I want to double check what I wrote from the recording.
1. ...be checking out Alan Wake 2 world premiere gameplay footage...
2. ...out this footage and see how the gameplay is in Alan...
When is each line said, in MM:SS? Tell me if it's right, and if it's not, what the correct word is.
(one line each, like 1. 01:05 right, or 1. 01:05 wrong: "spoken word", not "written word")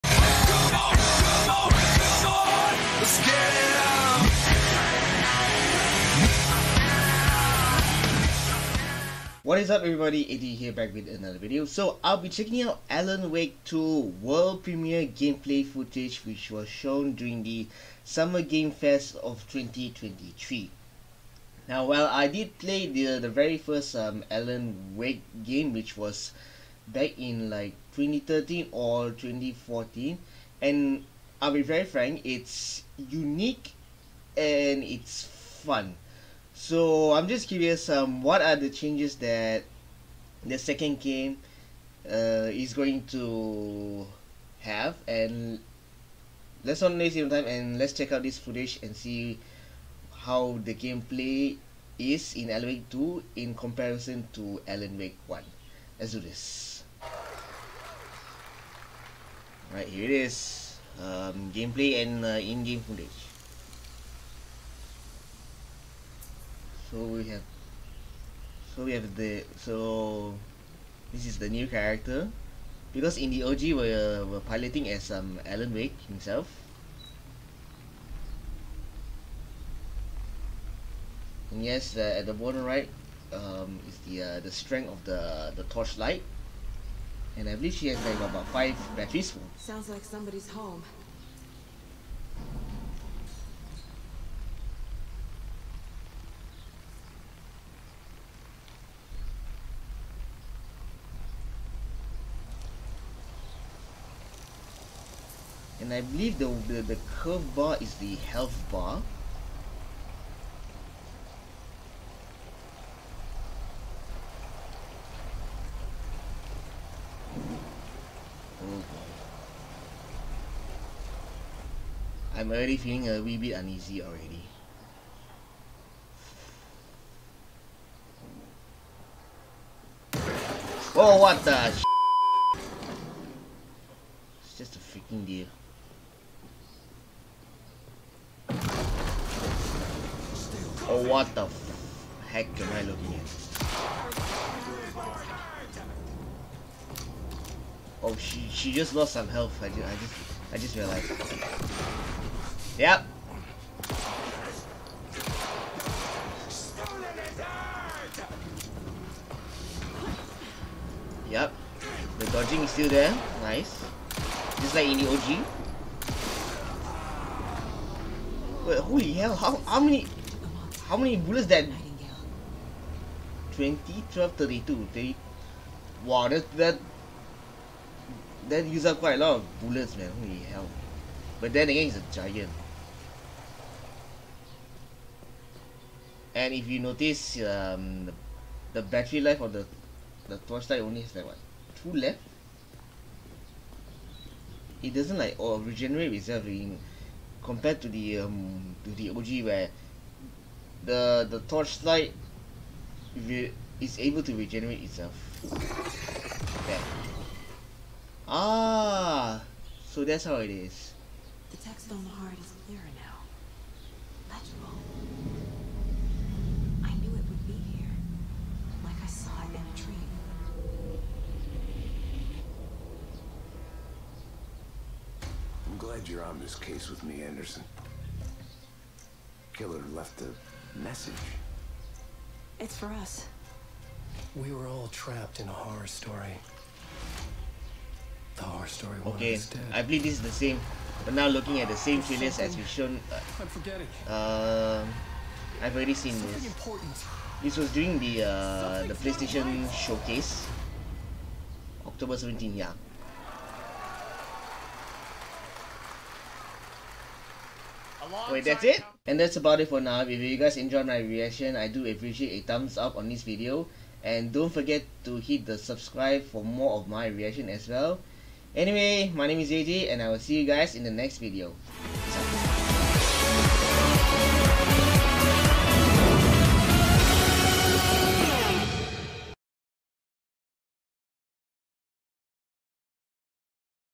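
1. 00:12 right
2. 00:48 right.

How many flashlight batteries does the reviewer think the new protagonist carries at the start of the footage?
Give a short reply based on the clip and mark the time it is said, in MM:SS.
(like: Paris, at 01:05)
5, at 01:28.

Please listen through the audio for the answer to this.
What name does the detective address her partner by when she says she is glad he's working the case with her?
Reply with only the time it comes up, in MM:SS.
03:47.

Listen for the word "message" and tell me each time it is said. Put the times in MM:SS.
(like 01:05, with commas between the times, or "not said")
03:50.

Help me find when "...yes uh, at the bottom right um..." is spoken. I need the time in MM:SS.
01:21.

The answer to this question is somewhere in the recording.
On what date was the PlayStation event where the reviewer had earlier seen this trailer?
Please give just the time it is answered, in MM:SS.
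04:11.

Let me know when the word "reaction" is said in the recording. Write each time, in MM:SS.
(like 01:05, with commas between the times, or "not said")
04:20, 04:27.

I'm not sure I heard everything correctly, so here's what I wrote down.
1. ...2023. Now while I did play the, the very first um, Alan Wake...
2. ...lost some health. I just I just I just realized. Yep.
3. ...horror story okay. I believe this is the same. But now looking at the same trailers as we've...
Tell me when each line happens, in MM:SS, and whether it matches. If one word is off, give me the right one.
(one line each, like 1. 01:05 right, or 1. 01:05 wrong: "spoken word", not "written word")
1. 00:19 right
2. 02:28 right
3. 03:58 right.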